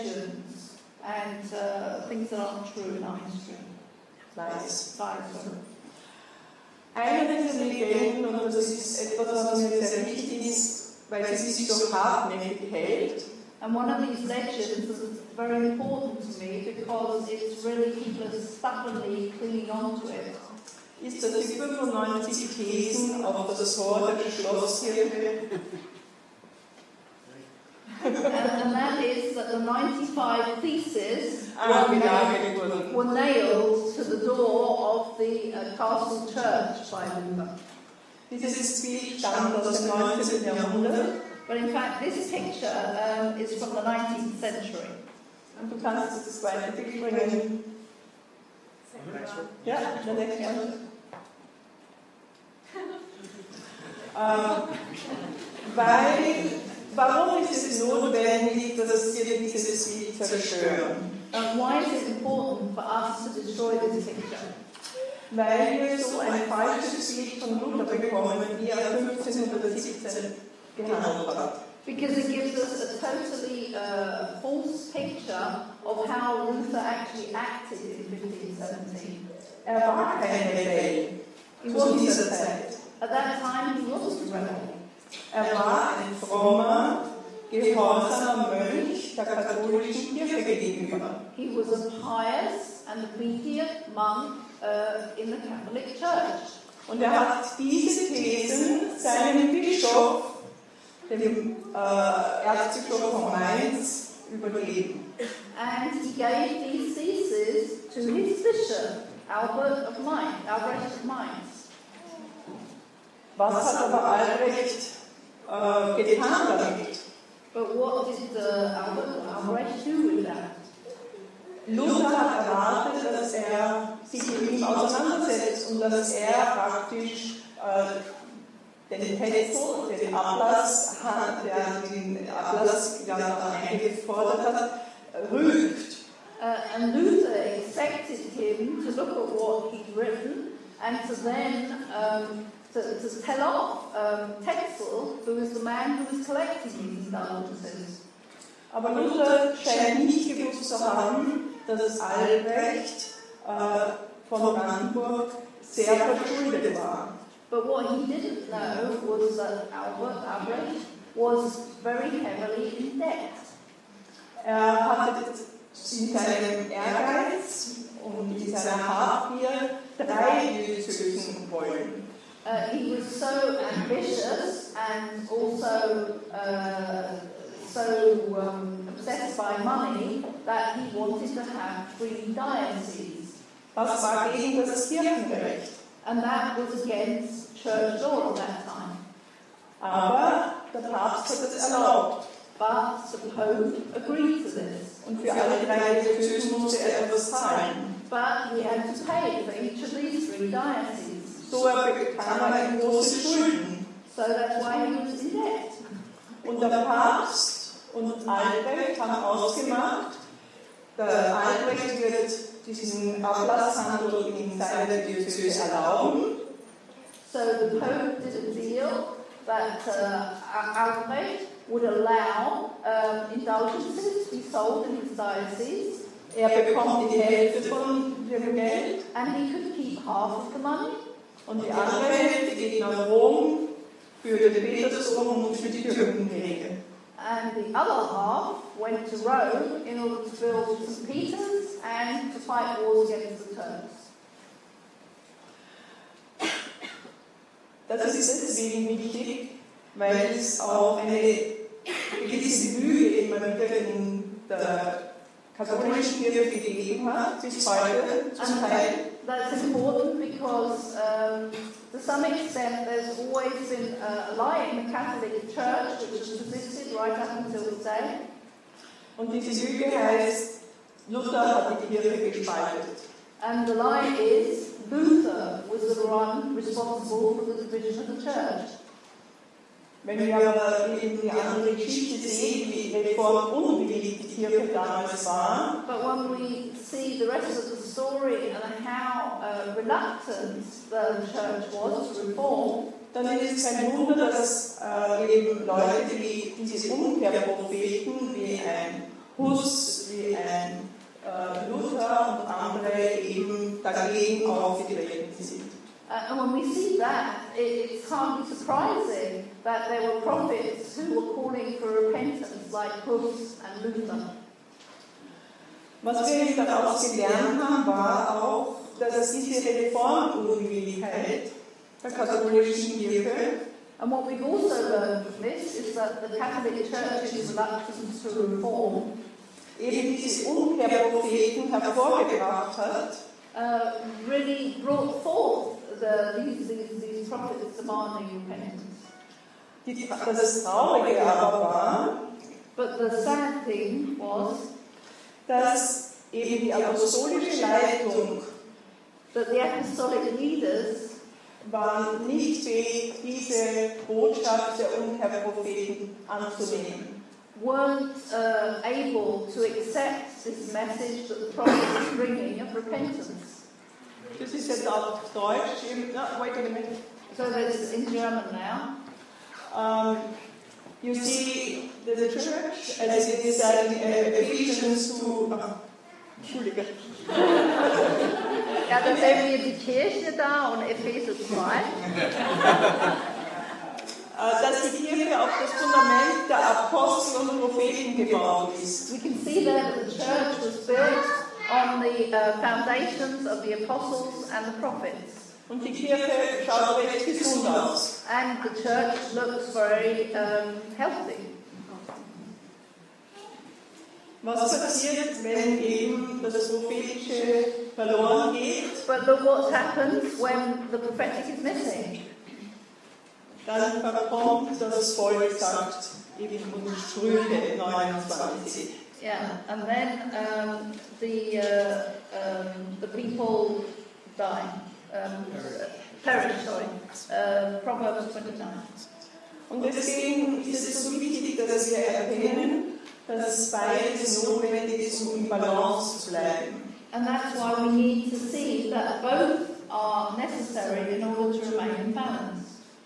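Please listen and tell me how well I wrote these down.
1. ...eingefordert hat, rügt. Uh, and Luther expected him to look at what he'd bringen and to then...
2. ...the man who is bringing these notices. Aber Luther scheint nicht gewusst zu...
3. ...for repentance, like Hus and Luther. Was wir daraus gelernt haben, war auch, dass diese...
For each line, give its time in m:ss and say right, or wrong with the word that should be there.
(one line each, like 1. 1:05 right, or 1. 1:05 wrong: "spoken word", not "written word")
1. 2:13 wrong: "written", not "bringen"
2. 2:25 wrong: "collecting", not "bringing"
3. 5:11 right.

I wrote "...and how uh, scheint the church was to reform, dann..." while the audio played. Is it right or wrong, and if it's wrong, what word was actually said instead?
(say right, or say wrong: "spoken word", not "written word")
wrong: "reluctant", not "scheint".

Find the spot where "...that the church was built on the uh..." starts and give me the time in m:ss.
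6:29.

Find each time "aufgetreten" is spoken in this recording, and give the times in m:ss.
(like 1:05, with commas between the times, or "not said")
5:04.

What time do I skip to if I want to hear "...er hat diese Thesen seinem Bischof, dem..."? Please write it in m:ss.
1:37.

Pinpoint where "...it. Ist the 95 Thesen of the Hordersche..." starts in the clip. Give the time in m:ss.
0:20.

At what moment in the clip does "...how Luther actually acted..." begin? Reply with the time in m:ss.
1:16.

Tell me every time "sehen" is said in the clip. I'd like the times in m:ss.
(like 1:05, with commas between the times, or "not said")
4:42, 6:19.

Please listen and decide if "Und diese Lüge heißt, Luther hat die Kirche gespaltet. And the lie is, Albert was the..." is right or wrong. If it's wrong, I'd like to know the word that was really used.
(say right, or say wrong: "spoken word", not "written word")
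wrong: "Luther", not "Albert".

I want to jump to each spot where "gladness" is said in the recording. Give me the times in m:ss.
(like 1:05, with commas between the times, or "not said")
not said.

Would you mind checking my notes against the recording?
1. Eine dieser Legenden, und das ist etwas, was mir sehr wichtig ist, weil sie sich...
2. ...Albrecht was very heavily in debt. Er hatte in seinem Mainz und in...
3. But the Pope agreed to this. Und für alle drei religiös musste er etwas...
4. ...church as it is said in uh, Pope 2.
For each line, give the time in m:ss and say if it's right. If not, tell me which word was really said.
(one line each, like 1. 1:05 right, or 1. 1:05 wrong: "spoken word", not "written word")
1. 0:06 right
2. 2:40 wrong: "Ehrgeiz", not "Mainz"
3. 3:12 right
4. 6:12 wrong: "Ephesians", not "Pope".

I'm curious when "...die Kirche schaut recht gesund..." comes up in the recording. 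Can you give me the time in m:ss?
6:35.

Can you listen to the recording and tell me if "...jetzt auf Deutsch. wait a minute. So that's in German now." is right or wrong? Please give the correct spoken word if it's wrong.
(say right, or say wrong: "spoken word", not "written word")
right.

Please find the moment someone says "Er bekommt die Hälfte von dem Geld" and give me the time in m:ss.
3:46.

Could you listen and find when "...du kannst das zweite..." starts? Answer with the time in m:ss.
0:45.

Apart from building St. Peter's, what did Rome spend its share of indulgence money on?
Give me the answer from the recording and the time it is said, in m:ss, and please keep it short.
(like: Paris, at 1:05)
Wars against the Turks, at 4:02.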